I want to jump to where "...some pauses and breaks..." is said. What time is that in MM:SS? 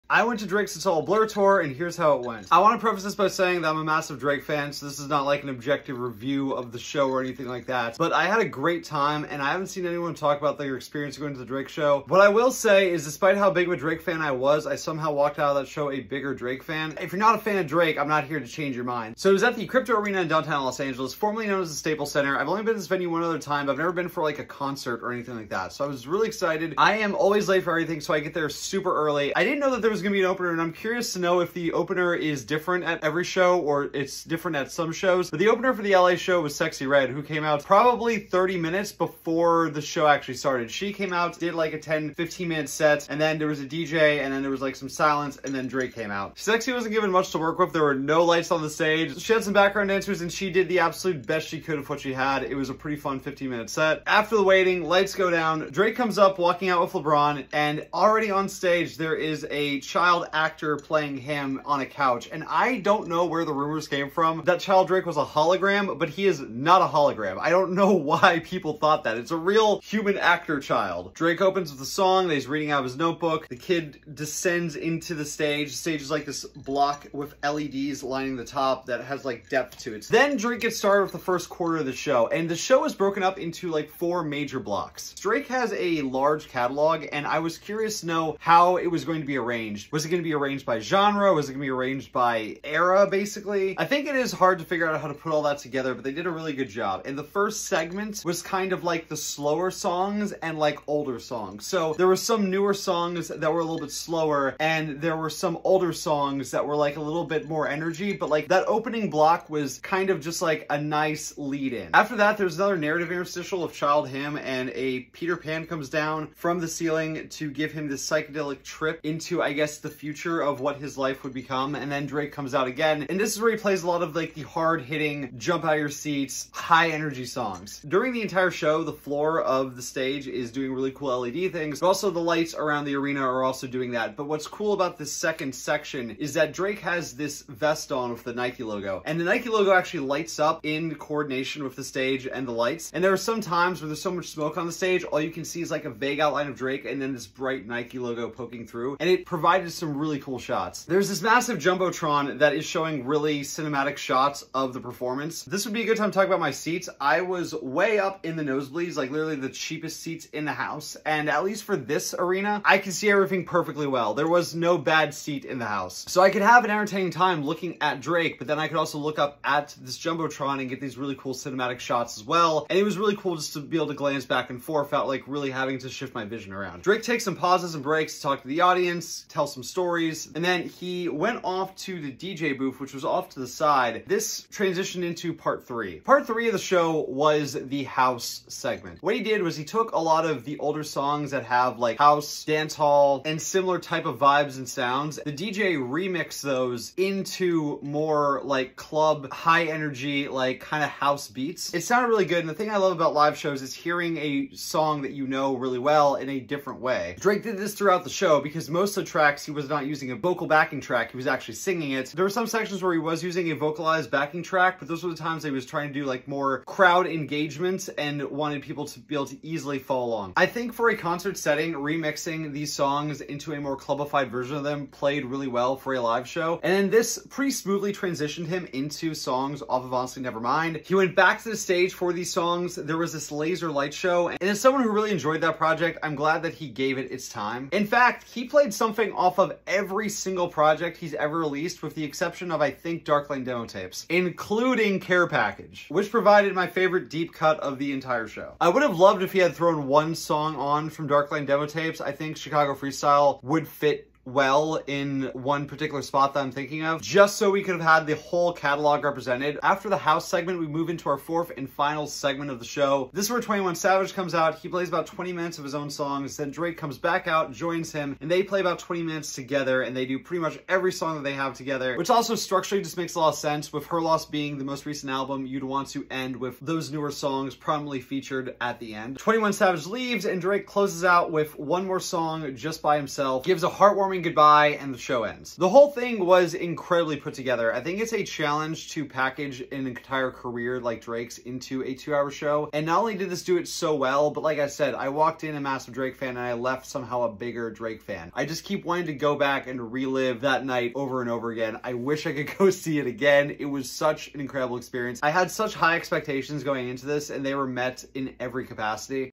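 02:57.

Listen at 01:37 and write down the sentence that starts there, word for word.
And the first segment was kind of like the slower songs and like older songs.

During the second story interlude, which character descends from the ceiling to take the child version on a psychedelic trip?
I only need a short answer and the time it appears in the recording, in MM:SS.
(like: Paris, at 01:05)
Peter Pan, at 01:55.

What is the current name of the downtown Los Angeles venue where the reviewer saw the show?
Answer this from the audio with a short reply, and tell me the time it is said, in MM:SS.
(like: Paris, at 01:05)
Crypto Arena, at 00:19.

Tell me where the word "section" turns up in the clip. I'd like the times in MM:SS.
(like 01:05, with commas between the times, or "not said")
02:15, 03:32.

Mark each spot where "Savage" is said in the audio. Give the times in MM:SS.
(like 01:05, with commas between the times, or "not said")
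04:23, 04:39.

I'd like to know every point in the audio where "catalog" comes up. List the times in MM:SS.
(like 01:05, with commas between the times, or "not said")
01:26, 04:18.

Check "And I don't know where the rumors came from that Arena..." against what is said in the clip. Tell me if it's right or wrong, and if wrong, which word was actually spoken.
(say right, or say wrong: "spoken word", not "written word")
wrong: "Child", not "Arena".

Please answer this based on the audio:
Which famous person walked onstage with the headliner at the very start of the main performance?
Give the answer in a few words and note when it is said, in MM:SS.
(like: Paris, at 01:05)
LeBron, at 00:56.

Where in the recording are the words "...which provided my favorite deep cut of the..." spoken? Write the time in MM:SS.
04:05.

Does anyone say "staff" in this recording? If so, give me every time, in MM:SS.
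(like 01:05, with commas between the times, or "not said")
not said.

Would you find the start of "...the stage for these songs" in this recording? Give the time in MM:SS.
03:51.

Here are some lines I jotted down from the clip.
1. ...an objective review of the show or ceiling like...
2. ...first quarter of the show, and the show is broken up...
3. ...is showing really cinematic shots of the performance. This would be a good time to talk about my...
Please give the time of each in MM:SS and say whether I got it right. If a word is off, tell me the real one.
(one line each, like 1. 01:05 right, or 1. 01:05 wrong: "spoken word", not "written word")
1. 00:05 wrong: "anything", not "ceiling"
2. 01:21 right
3. 02:32 right.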